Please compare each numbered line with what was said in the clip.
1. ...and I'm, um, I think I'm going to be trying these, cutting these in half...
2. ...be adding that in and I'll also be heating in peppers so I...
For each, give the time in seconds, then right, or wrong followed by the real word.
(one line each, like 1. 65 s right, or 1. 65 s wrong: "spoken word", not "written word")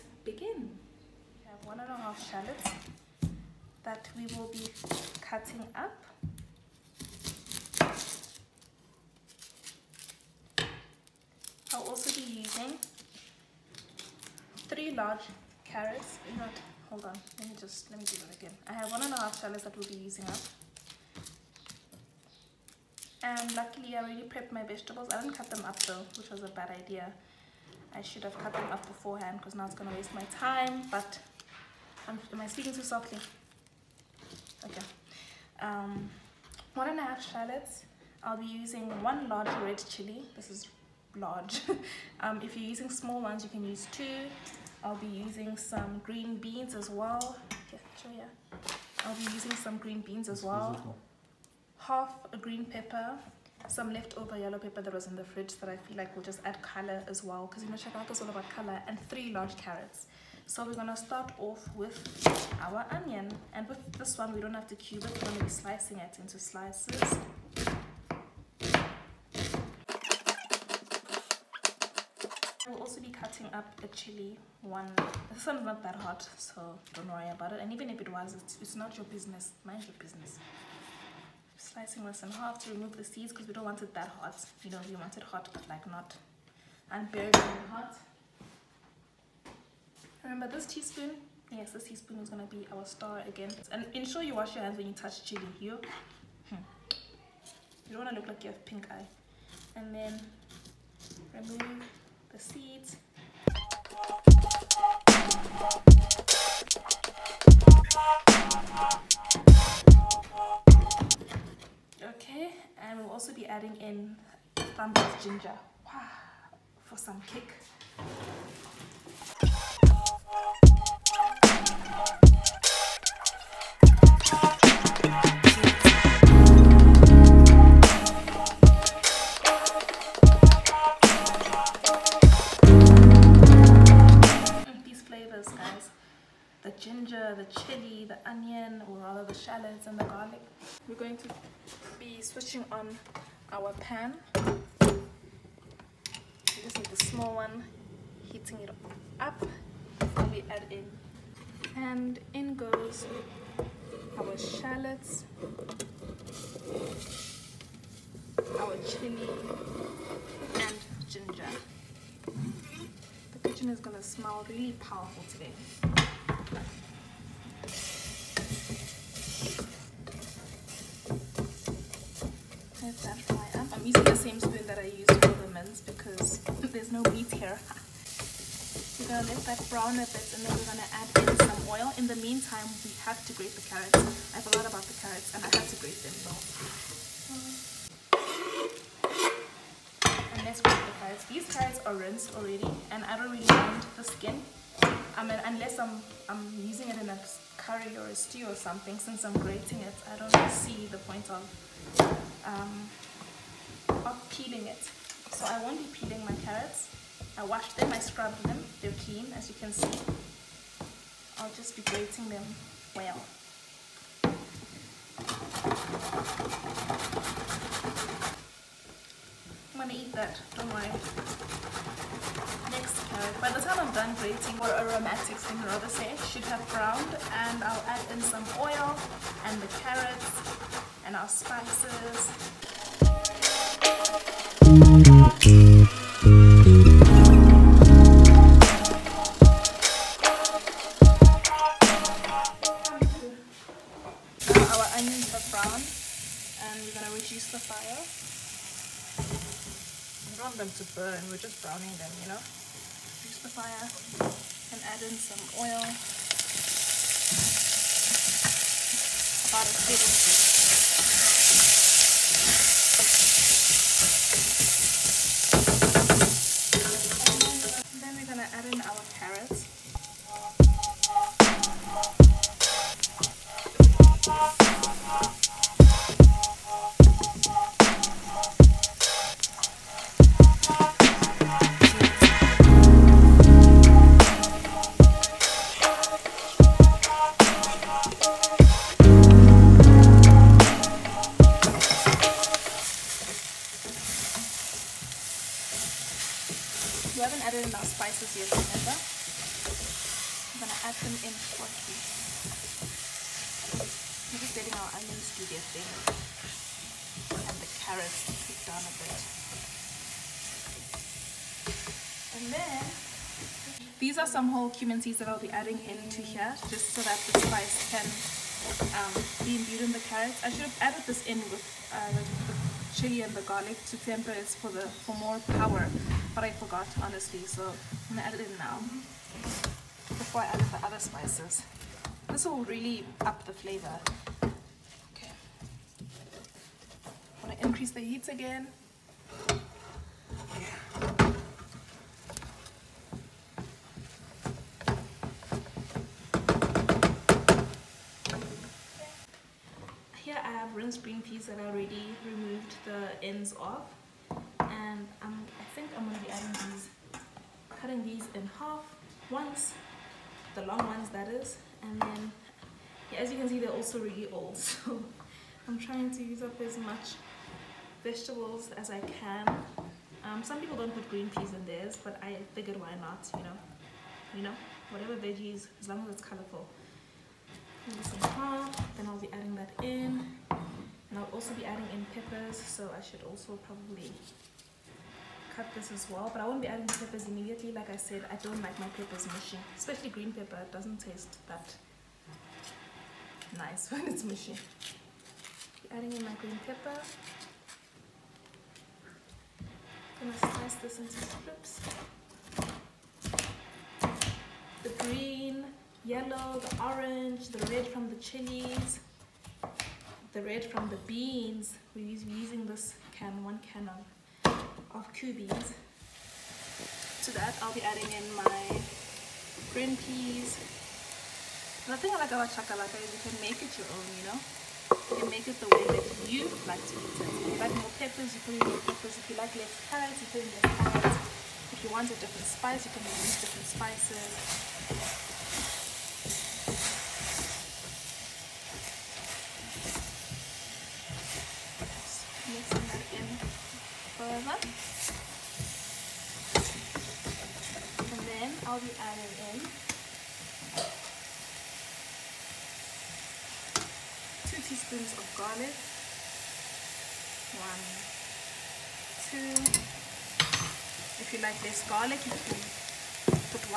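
1. 354 s wrong: "adding", not "trying"
2. 379 s wrong: "adding", not "heating".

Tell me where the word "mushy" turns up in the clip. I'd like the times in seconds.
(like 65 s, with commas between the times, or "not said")
389 s, 394 s.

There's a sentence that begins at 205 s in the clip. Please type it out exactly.
So I won't be peeling my carrots.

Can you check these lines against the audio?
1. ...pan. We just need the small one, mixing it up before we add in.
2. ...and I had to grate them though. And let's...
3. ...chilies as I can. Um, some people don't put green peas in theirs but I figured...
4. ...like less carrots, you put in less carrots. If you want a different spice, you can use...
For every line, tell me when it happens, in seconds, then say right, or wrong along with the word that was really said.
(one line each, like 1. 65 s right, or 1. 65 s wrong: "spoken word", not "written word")
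1. 143 s wrong: "heating", not "mixing"
2. 185 s right
3. 368 s wrong: "vegetables", not "chilies"
4. 429 s right.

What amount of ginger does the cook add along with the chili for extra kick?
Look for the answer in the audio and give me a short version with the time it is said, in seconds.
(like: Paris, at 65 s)
a thumb, at 114 s.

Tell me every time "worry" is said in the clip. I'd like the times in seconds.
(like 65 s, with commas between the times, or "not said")
77 s, 220 s.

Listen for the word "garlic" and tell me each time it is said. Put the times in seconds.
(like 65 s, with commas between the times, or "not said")
140 s, 323 s, 455 s, 461 s.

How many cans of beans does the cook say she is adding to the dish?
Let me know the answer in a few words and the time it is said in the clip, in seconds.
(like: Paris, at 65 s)
1, at 413 s.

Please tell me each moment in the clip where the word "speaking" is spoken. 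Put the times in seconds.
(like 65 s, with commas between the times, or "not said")
32 s.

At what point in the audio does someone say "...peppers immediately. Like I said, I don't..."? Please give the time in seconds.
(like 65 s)
386 s.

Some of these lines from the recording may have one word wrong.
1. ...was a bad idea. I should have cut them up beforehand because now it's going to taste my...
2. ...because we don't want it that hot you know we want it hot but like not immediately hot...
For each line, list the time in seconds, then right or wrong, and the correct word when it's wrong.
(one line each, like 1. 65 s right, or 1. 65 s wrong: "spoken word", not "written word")
1. 26 s wrong: "waste", not "taste"
2. 83 s wrong: "unbearably", not "immediately".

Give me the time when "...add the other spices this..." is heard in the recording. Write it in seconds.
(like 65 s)
330 s.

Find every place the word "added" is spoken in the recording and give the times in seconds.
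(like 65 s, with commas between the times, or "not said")
297 s, 320 s.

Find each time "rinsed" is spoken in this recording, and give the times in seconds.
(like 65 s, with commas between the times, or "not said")
191 s, 350 s.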